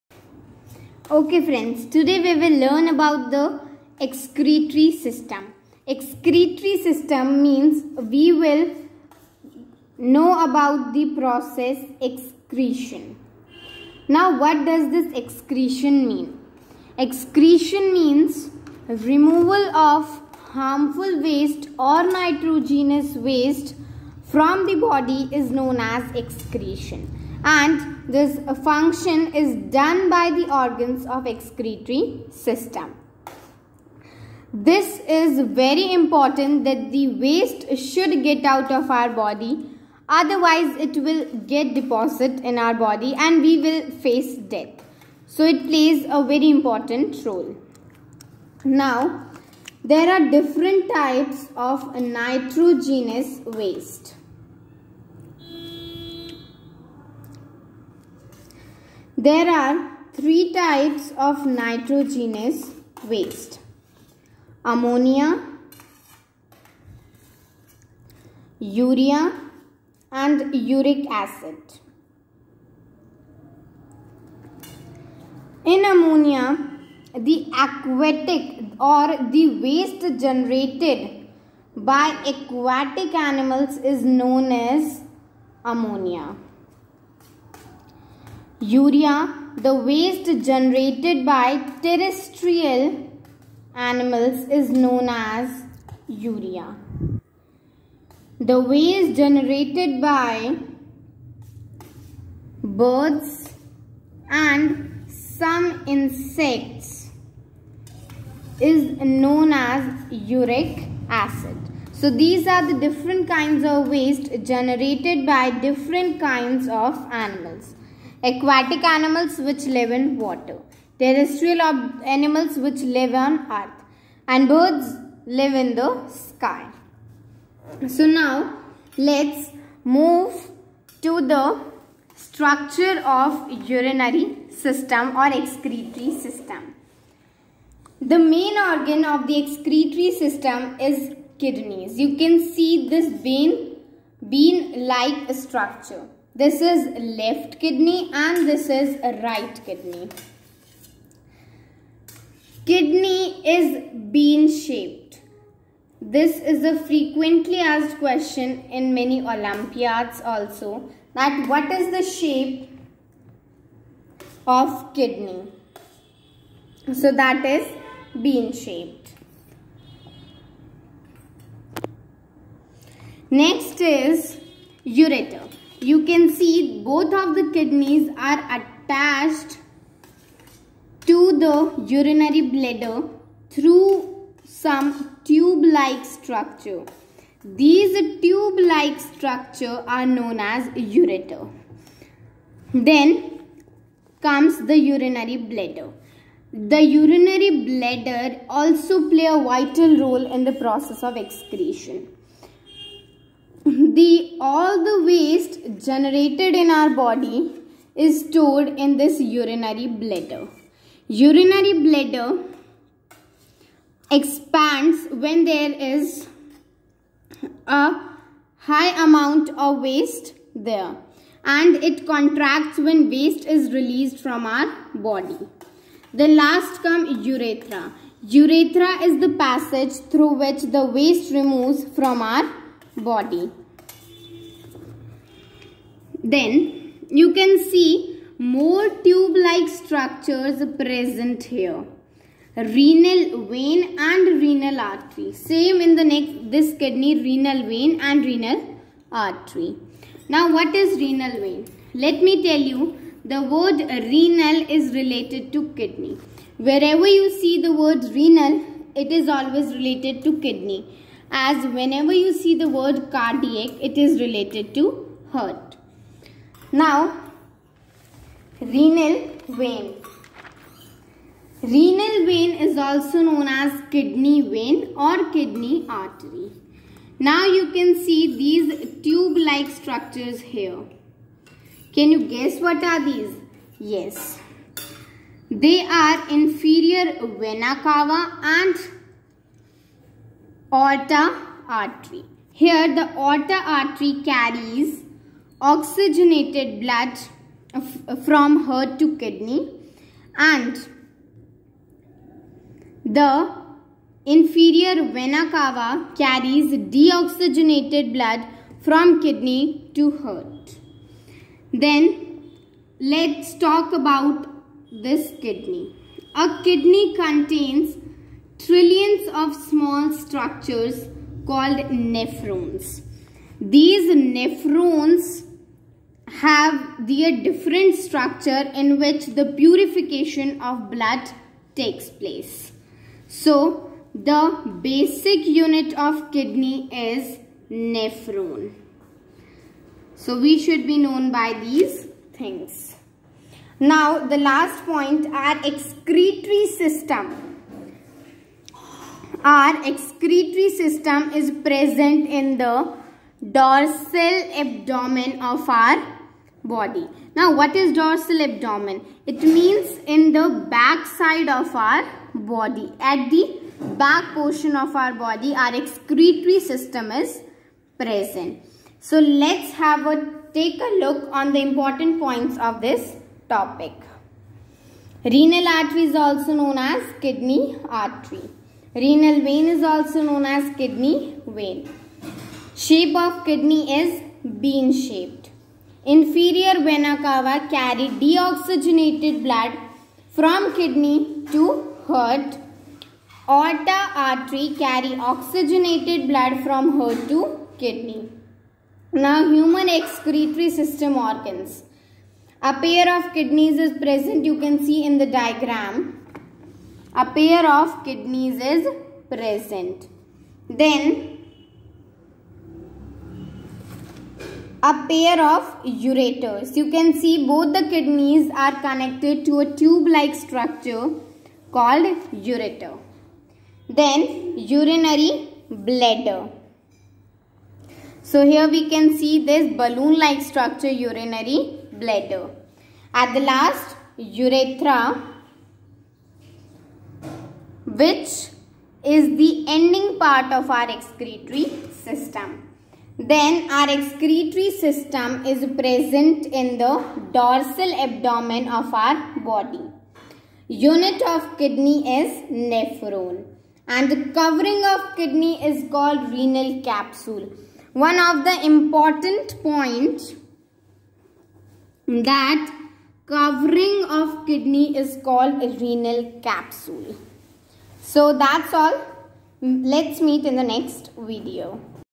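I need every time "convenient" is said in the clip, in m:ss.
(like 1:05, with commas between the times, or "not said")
not said.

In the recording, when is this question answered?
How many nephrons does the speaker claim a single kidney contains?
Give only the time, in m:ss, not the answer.
5:18.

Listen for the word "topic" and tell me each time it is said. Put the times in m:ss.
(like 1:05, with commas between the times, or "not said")
6:13.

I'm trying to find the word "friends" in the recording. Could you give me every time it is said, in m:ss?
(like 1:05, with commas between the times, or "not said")
0:01.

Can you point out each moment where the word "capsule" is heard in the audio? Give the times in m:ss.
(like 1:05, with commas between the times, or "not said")
7:36, 7:46.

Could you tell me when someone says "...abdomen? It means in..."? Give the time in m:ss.
5:58.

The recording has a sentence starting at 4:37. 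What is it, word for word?
Now you can see these tube-like structures here.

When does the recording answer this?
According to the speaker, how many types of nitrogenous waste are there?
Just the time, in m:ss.
1:00.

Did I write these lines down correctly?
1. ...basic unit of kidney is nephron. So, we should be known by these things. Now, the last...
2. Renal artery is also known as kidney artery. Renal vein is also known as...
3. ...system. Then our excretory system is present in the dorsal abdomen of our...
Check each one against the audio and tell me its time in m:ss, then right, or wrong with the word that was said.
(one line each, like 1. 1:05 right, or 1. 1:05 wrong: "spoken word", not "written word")
1. 5:34 right
2. 6:15 right
3. 7:21 right.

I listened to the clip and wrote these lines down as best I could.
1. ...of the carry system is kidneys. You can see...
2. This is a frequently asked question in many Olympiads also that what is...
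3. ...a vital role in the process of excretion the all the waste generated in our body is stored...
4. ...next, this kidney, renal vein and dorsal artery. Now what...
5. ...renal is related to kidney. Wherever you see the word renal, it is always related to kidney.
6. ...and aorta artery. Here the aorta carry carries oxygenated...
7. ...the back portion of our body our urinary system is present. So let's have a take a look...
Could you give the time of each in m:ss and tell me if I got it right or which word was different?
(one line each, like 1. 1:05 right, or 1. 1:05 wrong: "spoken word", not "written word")
1. 2:19 wrong: "excretory", not "carry"
2. 2:36 right
3. 3:19 right
4. 4:06 wrong: "renal", not "dorsal"
5. 4:13 right
6. 4:48 wrong: "artery", not "carry"
7. 6:03 wrong: "excretory", not "urinary".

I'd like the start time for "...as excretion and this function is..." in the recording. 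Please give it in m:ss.
0:25.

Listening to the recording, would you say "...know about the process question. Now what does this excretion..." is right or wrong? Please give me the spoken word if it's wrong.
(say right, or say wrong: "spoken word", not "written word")
wrong: "excretion", not "question".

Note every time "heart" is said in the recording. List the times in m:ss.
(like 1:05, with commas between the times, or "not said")
4:25, 4:58, 5:10, 6:32, 6:36.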